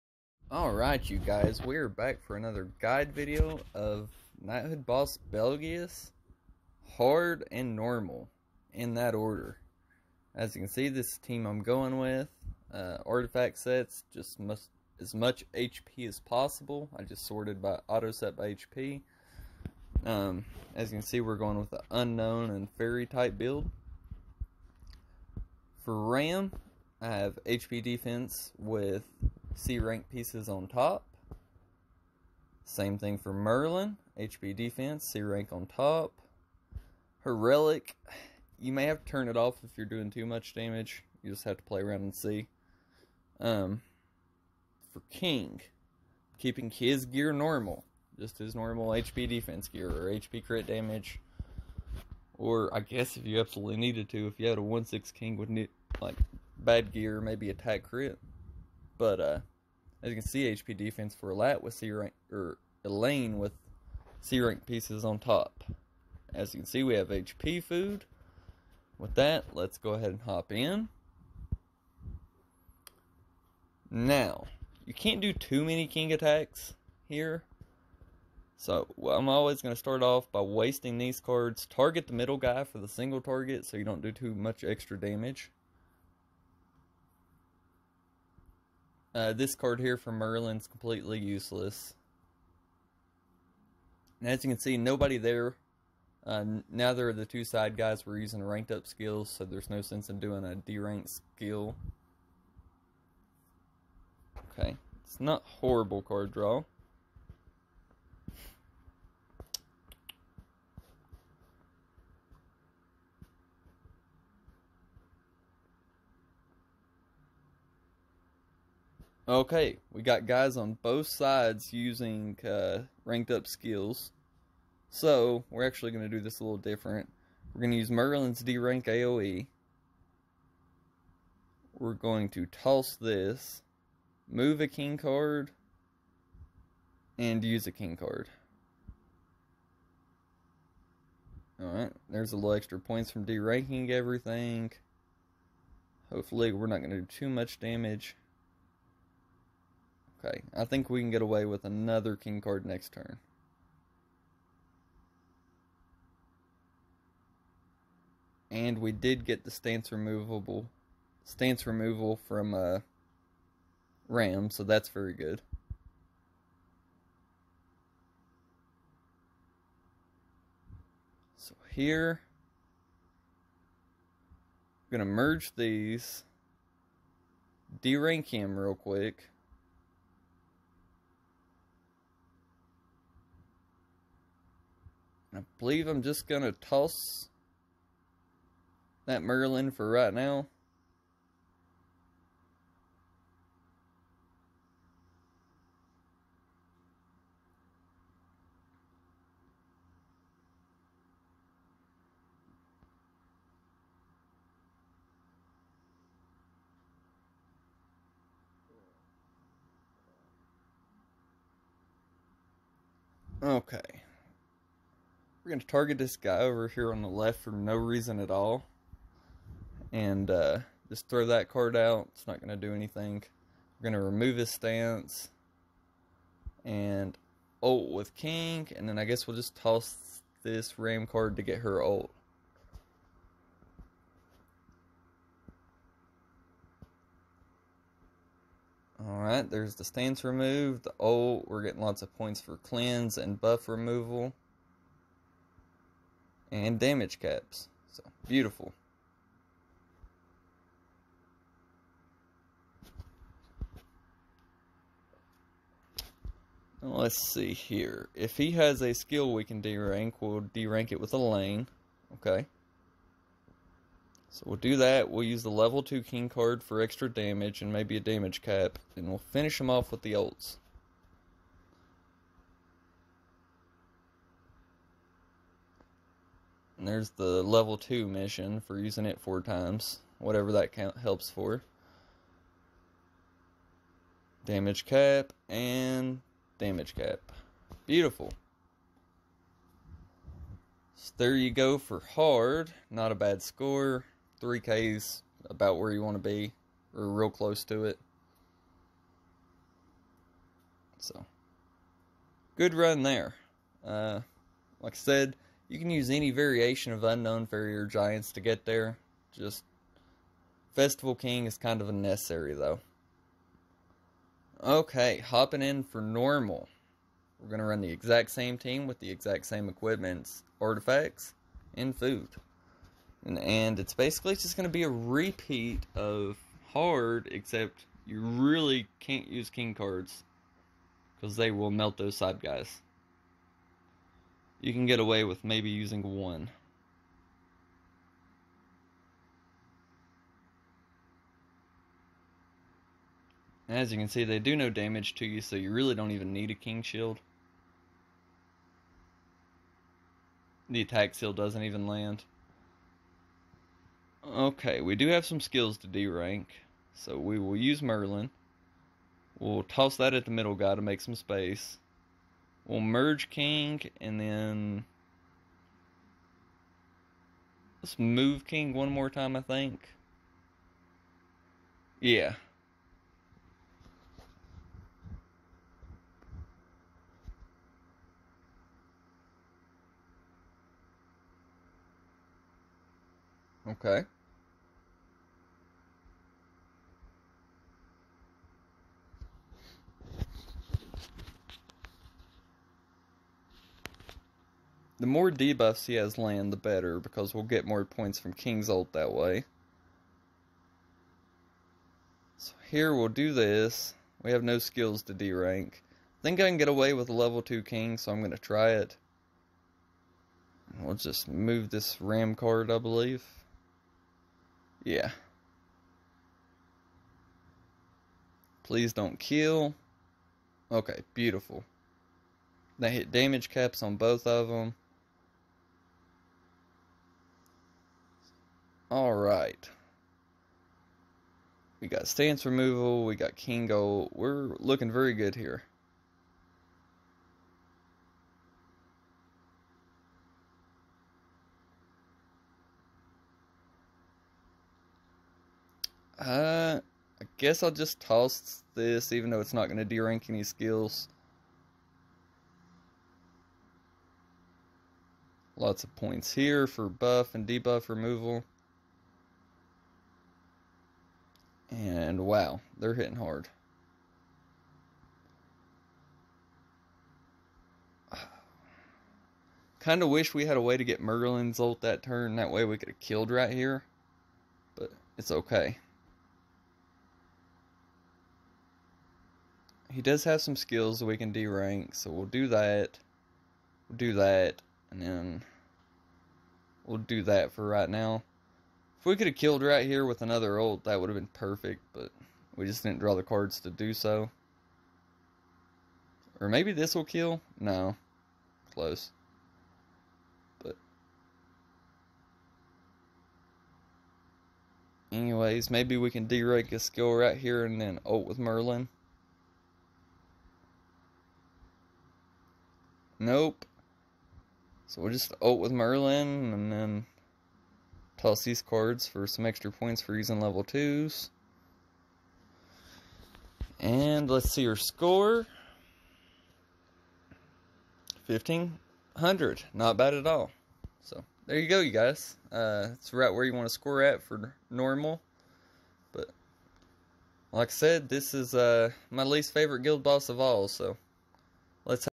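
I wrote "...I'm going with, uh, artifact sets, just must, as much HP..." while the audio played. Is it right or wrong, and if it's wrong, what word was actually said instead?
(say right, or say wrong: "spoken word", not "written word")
right.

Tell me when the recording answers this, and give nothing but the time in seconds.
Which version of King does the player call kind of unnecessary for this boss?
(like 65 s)
310 s.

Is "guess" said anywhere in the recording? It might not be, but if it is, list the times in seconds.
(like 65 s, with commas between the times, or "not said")
52 s, 229 s, 447 s.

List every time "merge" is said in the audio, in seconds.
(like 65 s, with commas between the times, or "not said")
175 s, 362 s.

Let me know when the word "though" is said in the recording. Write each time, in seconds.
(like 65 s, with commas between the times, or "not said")
312 s, 449 s.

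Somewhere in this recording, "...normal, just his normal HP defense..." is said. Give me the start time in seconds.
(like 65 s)
47 s.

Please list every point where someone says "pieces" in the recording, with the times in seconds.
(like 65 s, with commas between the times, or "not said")
30 s, 64 s.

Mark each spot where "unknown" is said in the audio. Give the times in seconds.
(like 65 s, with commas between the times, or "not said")
21 s, 307 s.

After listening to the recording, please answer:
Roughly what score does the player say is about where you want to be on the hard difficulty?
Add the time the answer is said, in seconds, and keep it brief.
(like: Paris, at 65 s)
3K, at 294 s.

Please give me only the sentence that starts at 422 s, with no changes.
They hit damage caps on both of them.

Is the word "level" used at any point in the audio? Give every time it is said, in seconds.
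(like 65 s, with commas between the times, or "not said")
265 s, 277 s, 407 s, 520 s.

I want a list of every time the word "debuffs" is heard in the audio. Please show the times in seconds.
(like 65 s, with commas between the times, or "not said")
395 s, 457 s.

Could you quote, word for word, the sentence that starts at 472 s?
That way we could have killed right here.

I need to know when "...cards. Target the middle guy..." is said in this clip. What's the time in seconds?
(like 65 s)
81 s.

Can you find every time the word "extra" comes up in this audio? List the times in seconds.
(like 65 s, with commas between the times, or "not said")
84 s, 142 s, 266 s, 519 s.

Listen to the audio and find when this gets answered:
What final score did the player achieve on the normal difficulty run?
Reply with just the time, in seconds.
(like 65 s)
528 s.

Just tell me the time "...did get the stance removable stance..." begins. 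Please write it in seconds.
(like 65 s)
158 s.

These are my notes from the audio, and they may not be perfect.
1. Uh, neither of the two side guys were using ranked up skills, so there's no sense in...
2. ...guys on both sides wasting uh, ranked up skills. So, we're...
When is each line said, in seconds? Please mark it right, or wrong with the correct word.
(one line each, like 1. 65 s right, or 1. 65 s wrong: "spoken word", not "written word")
1. 96 s right
2. 120 s wrong: "using", not "wasting".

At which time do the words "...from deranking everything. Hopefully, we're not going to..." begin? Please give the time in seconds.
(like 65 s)
143 s.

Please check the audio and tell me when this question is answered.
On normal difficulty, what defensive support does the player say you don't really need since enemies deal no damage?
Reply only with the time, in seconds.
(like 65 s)
346 s.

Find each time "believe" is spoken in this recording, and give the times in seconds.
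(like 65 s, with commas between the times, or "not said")
185 s, 412 s.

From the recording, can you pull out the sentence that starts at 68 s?
With that, let's go ahead and hop in.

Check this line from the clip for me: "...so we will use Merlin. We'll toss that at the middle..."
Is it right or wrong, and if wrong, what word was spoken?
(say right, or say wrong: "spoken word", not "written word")
right.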